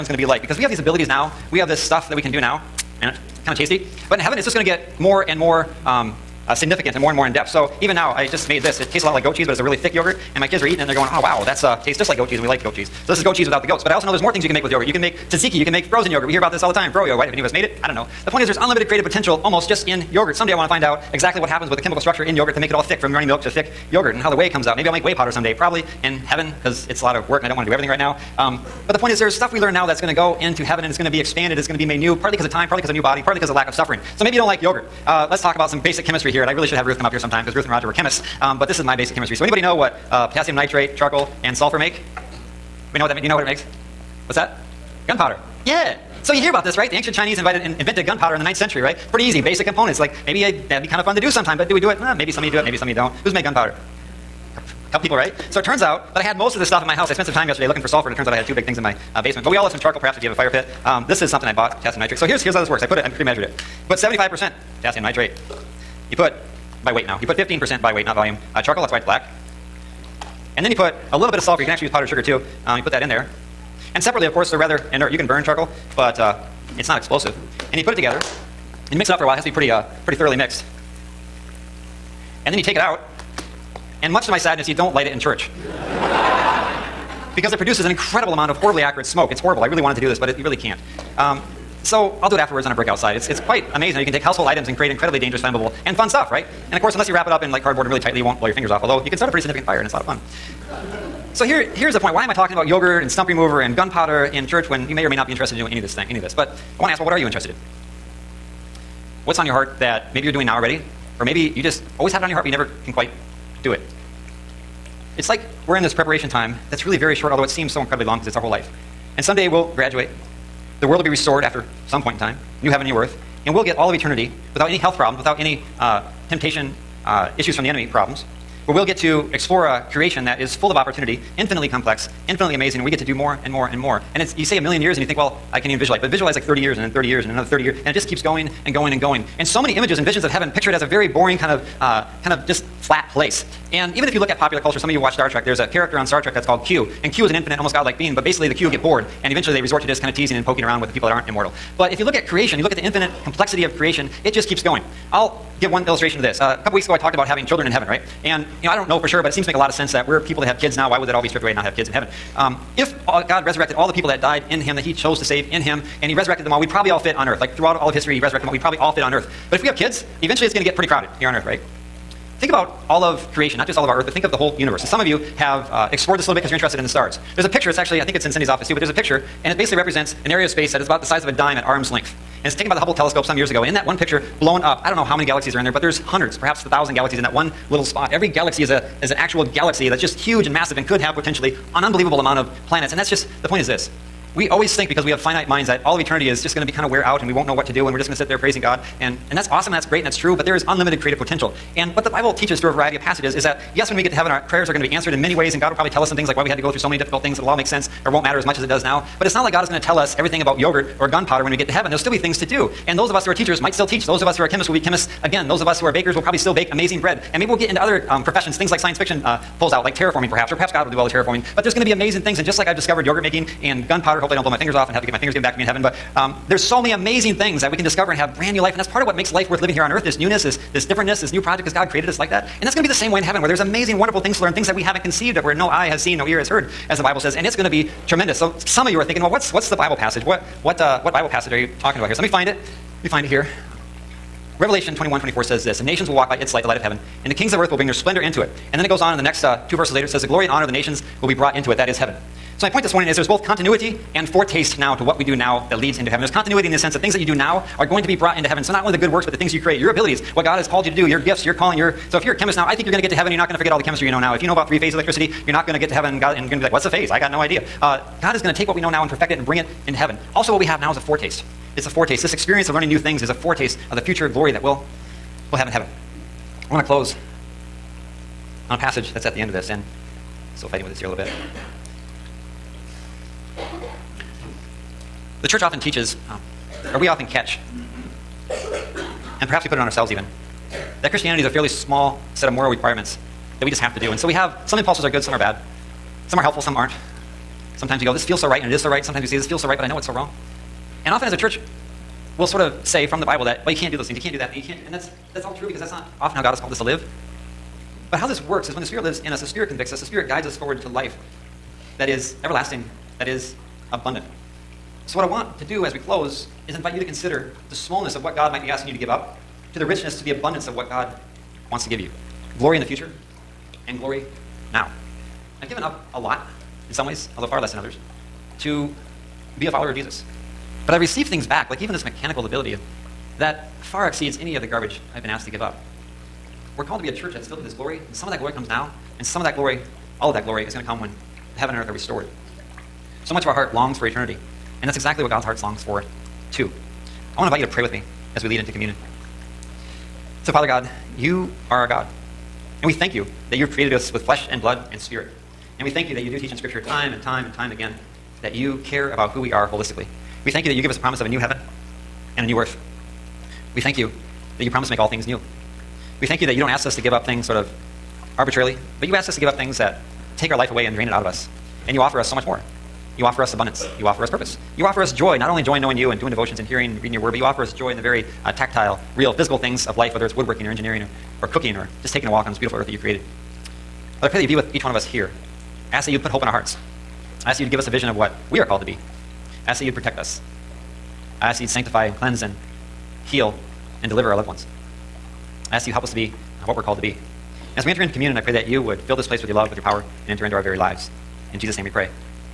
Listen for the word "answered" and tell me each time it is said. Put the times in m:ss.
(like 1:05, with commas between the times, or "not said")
3:24.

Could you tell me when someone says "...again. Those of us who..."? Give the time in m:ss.
3:35.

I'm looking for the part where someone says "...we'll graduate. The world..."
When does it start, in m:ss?
1:59.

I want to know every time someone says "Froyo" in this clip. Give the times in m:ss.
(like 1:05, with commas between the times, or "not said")
0:16.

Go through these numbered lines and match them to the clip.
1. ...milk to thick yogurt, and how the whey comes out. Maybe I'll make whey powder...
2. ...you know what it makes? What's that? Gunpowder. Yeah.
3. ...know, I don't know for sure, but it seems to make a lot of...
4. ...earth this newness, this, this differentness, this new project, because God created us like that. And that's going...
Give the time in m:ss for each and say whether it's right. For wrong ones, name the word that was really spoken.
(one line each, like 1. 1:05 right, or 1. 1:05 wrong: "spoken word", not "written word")
1. 0:23 right
2. 0:43 right
3. 2:38 right
4. 3:49 right.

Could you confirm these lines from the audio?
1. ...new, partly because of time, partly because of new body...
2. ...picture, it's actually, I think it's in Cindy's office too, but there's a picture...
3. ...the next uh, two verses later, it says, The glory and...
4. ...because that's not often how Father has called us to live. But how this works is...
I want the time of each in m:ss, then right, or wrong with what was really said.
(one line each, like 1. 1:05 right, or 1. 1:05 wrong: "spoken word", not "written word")
1. 0:31 right
2. 2:57 right
3. 4:09 right
4. 5:05 wrong: "God", not "Father".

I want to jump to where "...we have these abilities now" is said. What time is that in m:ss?
0:00.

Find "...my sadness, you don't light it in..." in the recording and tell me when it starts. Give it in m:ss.
1:24.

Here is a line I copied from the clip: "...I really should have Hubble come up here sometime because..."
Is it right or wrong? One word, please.
wrong.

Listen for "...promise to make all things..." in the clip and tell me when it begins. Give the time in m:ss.
6:04.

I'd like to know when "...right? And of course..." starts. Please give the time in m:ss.
1:36.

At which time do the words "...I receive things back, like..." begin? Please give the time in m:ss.
5:30.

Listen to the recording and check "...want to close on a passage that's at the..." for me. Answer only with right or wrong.
right.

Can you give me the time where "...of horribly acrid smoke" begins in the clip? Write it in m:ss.
1:28.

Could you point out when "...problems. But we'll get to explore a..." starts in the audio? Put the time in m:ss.
2:07.